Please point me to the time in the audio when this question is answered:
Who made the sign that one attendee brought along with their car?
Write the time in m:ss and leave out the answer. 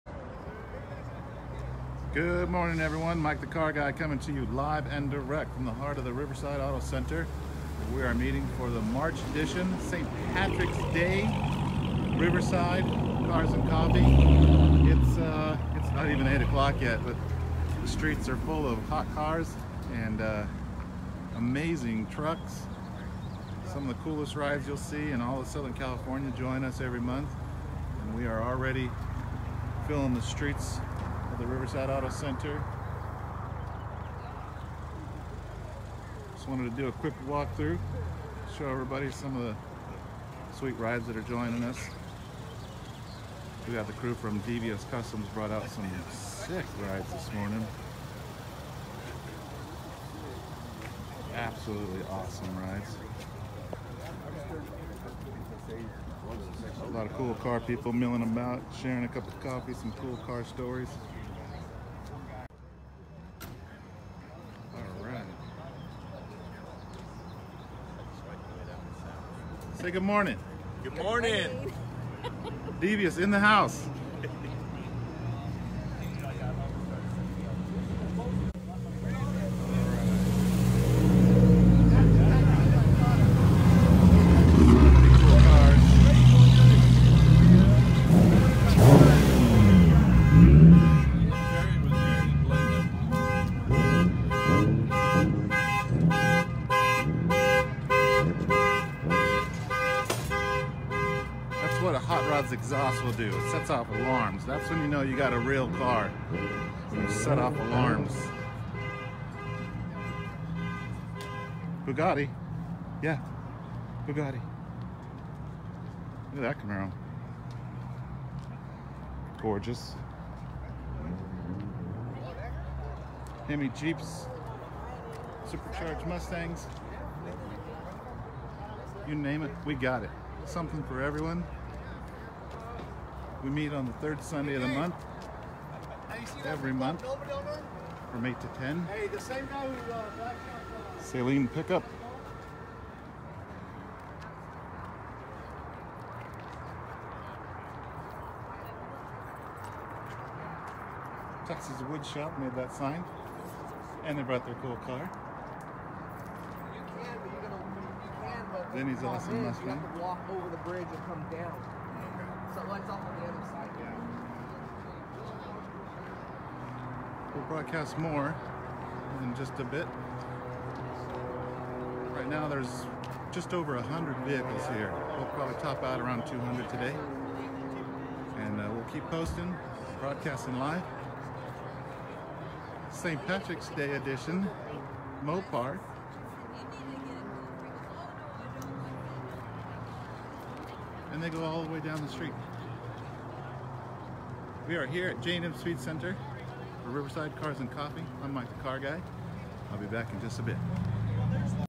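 2:31.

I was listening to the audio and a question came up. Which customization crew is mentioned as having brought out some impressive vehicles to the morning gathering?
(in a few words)
DVS Customs.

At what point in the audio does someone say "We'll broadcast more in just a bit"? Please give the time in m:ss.
2:47.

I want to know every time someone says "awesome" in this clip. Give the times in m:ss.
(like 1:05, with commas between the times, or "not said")
0:52, 2:39.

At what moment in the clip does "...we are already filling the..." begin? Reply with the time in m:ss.
0:28.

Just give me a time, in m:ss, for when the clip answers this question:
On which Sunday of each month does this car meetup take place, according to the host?
2:13.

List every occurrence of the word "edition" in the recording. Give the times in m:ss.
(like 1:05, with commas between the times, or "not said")
0:09, 3:03.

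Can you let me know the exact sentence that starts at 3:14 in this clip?
We are here at J&M Speed Center for Riverside Cars and Coffee.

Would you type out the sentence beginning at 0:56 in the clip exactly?
A lot of cool car people milling about, sharing a cup of coffee, some cool car stories.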